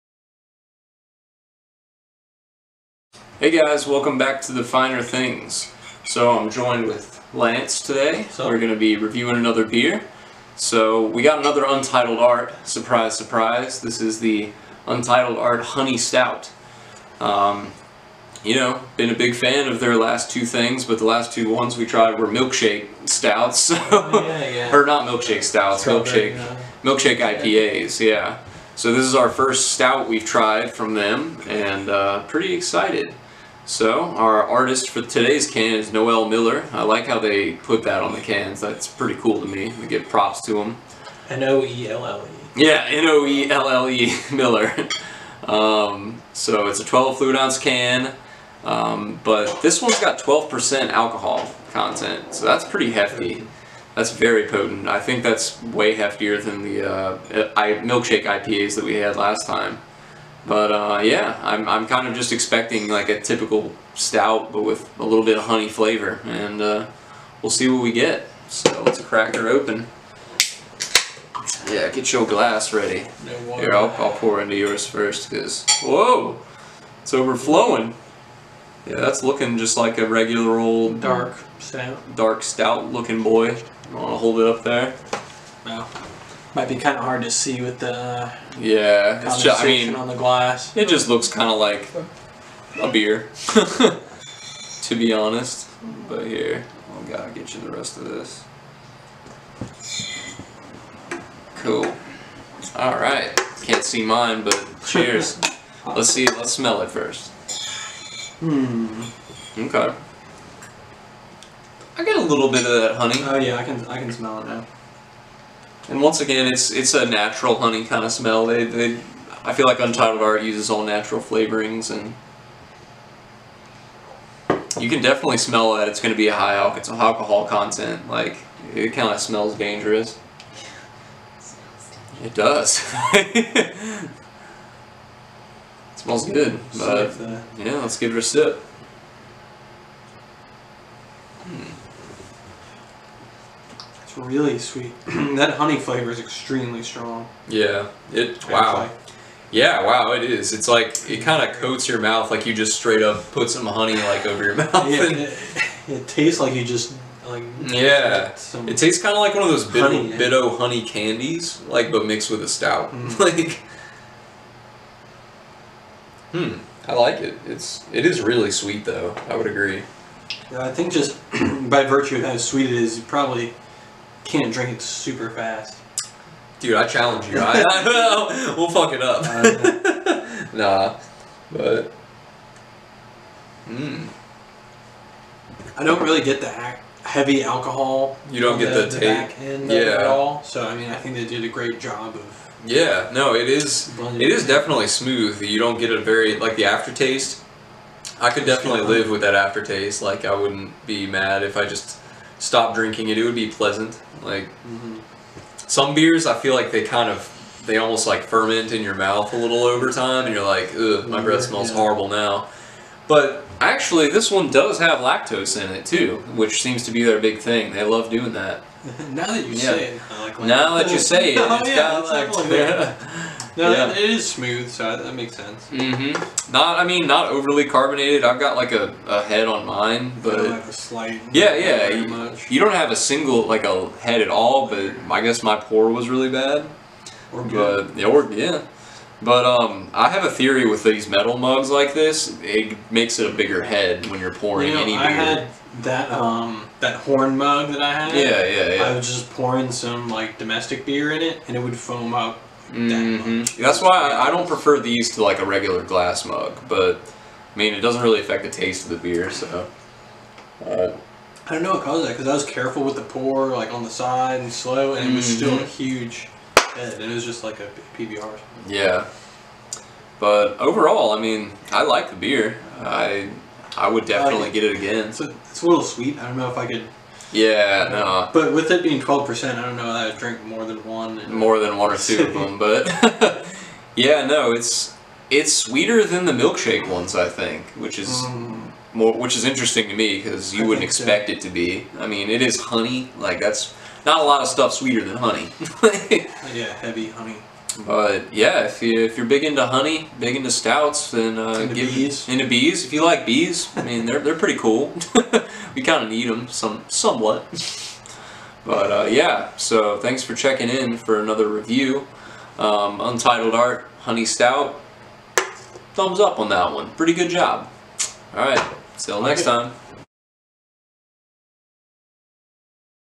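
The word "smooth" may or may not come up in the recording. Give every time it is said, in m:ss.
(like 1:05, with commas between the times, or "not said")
3:14, 3:44.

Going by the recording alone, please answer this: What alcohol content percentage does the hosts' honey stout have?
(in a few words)
12%.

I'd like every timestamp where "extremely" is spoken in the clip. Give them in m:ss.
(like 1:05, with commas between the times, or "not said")
2:26.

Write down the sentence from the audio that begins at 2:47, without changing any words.
It's it is really sweet though.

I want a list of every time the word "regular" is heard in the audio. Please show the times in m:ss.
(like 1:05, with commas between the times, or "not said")
1:20, 4:15.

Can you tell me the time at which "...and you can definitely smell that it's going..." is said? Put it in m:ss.
2:01.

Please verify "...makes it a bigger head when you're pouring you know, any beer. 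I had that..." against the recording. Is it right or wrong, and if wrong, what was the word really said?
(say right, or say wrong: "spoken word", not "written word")
right.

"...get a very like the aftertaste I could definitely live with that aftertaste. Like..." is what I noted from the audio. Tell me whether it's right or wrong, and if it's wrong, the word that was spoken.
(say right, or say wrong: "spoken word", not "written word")
right.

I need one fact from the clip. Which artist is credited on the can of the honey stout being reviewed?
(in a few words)
Noelle Miller.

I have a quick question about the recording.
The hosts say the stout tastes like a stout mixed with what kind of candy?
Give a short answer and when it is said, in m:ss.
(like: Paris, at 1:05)
honey candies, at 2:40.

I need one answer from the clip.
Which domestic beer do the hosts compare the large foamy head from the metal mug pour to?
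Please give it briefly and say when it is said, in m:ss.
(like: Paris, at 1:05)
PBR, at 4:27.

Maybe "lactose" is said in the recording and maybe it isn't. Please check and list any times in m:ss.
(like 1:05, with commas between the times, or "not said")
3:34, 3:42.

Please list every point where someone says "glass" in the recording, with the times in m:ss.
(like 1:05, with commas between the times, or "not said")
1:12, 1:30, 4:15.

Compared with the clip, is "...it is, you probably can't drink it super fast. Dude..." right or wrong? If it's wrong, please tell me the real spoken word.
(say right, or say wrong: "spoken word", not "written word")
right.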